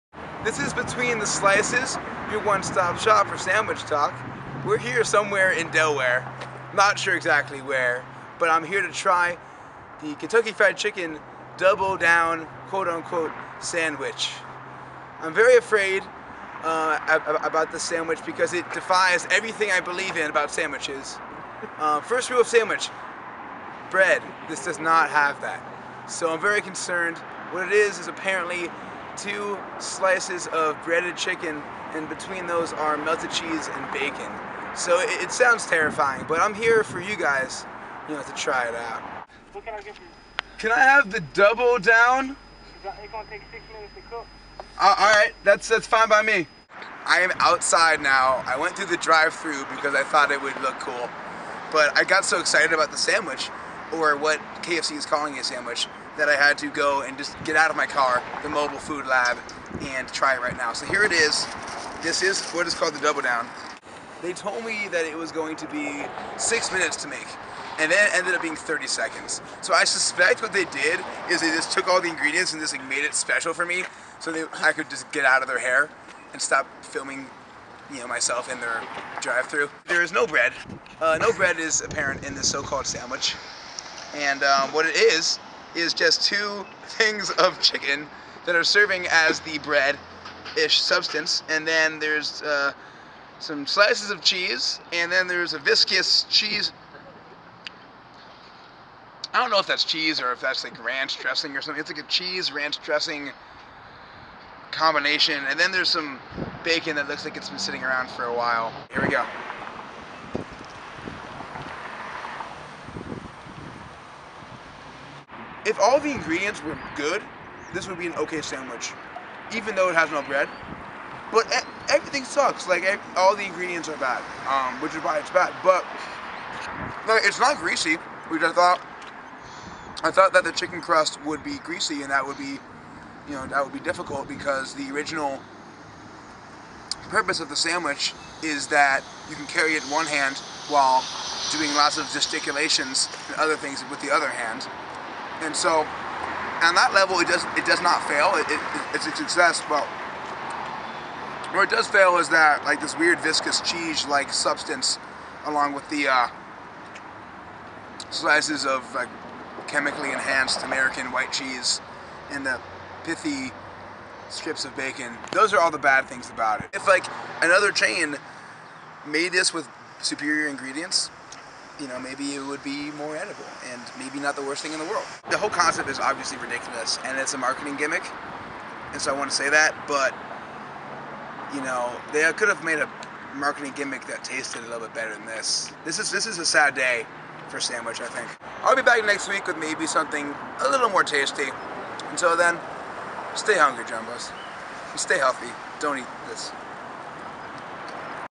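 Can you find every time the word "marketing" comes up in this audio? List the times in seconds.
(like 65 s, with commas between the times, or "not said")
177 s, 183 s.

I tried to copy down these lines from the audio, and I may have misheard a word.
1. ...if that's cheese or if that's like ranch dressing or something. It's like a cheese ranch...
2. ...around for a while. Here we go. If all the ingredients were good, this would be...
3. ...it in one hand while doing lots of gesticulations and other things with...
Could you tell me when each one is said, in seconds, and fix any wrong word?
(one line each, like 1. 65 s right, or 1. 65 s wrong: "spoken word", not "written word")
1. 99 s right
2. 107 s right
3. 139 s right.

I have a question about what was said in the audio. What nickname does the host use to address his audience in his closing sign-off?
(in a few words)
Jumbos.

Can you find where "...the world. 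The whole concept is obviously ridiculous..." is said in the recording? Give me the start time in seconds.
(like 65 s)
174 s.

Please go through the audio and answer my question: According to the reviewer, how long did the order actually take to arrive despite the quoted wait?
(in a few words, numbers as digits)
30 seconds.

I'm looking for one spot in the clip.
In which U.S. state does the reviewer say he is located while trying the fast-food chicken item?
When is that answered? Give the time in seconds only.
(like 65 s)
5 s.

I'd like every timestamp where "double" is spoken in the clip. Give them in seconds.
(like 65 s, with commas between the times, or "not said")
11 s, 41 s, 62 s.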